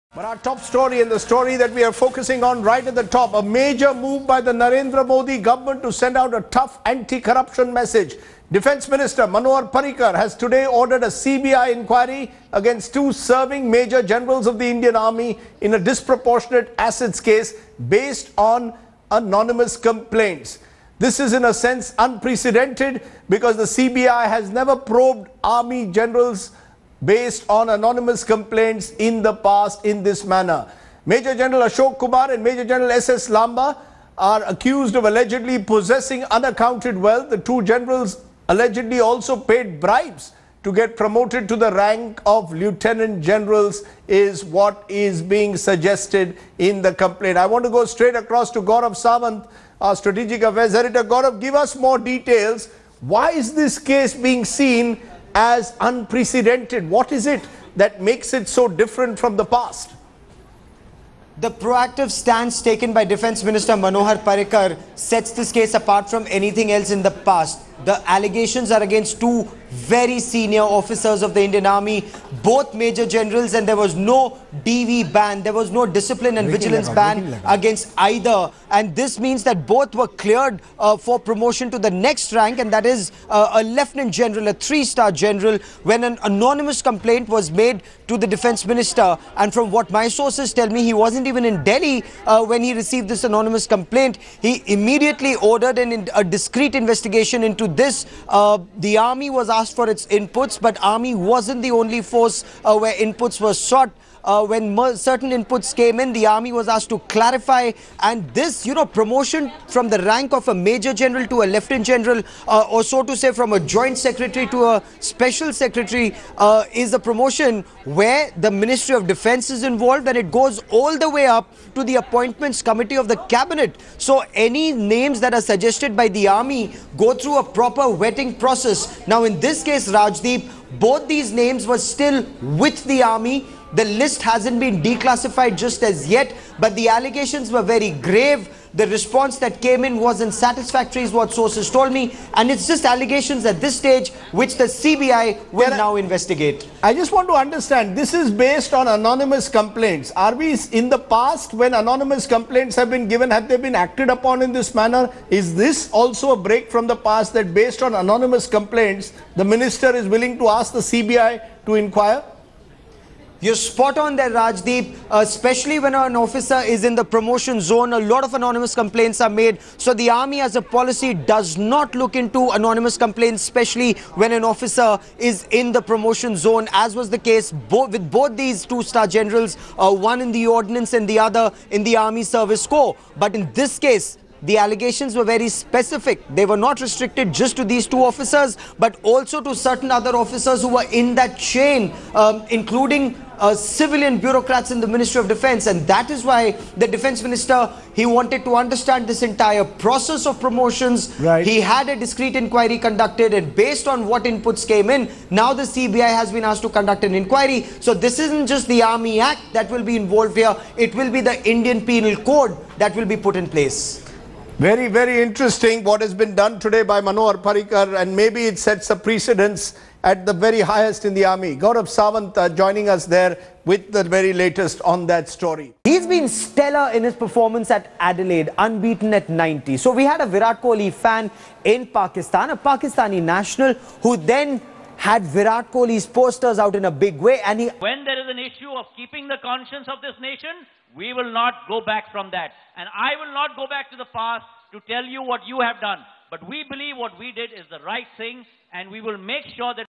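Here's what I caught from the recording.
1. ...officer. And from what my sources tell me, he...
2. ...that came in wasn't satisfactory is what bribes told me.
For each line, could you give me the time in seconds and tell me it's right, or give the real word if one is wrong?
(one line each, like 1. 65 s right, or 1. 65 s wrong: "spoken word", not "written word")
1. 88 s wrong: "minister", not "officer"
2. 139 s wrong: "sources", not "bribes".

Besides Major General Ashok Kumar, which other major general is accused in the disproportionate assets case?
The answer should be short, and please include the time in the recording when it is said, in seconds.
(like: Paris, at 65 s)
S.S. Lamba, at 32 s.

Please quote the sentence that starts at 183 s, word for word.
But in this case, the allegations were very specific.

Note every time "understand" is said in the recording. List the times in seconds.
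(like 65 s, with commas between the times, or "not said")
147 s, 198 s.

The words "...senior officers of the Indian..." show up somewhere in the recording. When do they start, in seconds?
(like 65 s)
70 s.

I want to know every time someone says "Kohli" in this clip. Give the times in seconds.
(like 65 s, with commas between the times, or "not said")
230 s, 235 s.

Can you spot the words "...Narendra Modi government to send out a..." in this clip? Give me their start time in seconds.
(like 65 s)
4 s.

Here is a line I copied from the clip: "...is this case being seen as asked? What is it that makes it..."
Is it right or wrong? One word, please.
wrong.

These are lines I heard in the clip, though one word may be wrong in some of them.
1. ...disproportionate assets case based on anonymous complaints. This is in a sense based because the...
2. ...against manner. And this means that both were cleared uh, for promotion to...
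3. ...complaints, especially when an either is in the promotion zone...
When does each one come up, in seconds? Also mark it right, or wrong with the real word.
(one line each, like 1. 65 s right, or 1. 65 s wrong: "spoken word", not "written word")
1. 15 s wrong: "unprecedented", not "based"
2. 77 s wrong: "either", not "manner"
3. 172 s wrong: "officer", not "either".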